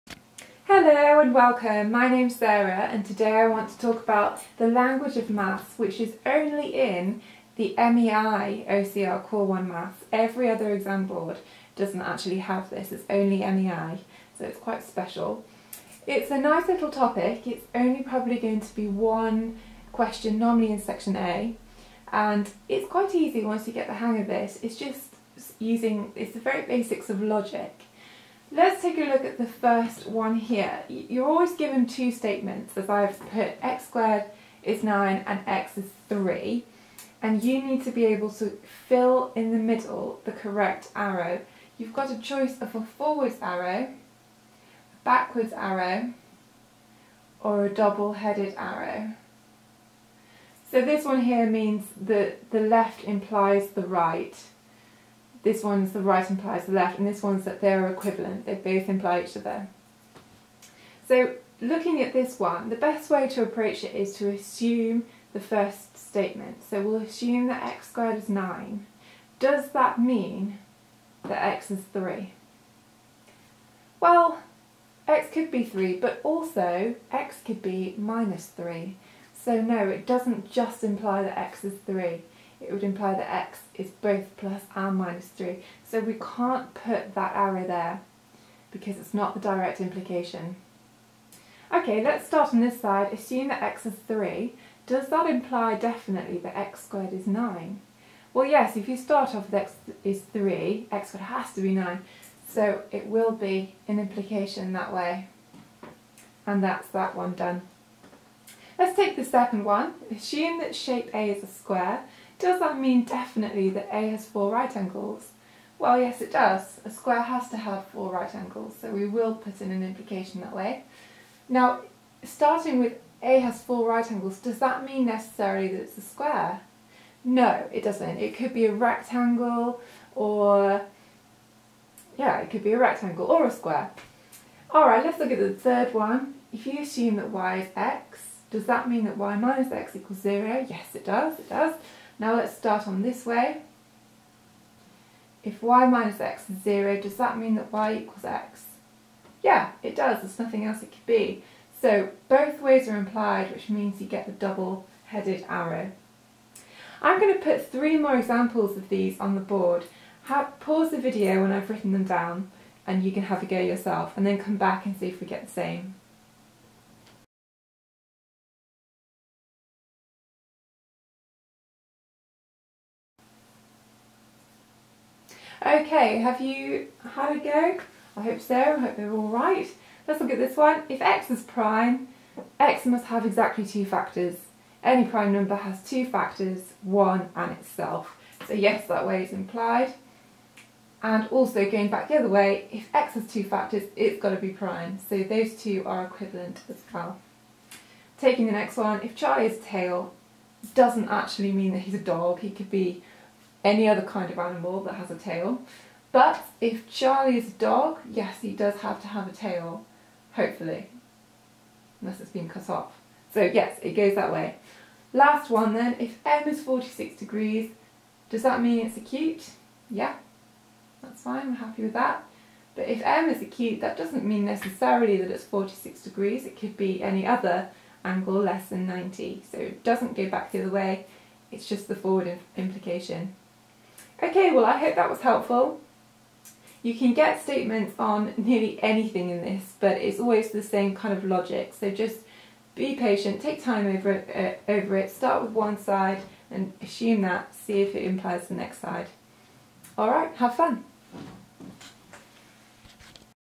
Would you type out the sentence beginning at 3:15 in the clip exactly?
So those two are equivalent as well.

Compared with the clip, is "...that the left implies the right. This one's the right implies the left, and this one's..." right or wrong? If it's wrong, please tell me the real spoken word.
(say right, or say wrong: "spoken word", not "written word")
right.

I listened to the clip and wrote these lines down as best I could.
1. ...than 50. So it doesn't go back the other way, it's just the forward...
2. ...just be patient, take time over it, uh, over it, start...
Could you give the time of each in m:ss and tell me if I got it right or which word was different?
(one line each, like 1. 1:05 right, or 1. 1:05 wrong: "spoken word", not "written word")
1. 3:48 wrong: "90", not "50"
2. 4:01 right.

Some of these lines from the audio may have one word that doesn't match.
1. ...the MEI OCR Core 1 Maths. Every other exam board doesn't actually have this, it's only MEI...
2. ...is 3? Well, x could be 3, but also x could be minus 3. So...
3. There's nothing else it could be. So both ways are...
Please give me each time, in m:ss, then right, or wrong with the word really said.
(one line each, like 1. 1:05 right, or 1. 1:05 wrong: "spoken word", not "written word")
1. 0:07 right
2. 1:11 right
3. 2:30 right.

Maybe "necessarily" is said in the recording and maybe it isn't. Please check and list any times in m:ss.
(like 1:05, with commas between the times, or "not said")
2:05, 3:44.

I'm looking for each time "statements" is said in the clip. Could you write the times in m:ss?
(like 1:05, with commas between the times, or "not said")
0:32, 1:05, 3:57.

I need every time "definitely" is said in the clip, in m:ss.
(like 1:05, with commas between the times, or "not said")
1:35, 1:53.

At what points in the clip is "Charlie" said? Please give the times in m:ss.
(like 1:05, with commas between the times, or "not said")
3:19, 3:26.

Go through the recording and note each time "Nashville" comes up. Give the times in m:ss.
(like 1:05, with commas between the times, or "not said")
not said.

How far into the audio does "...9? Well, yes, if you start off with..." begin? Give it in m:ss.
1:37.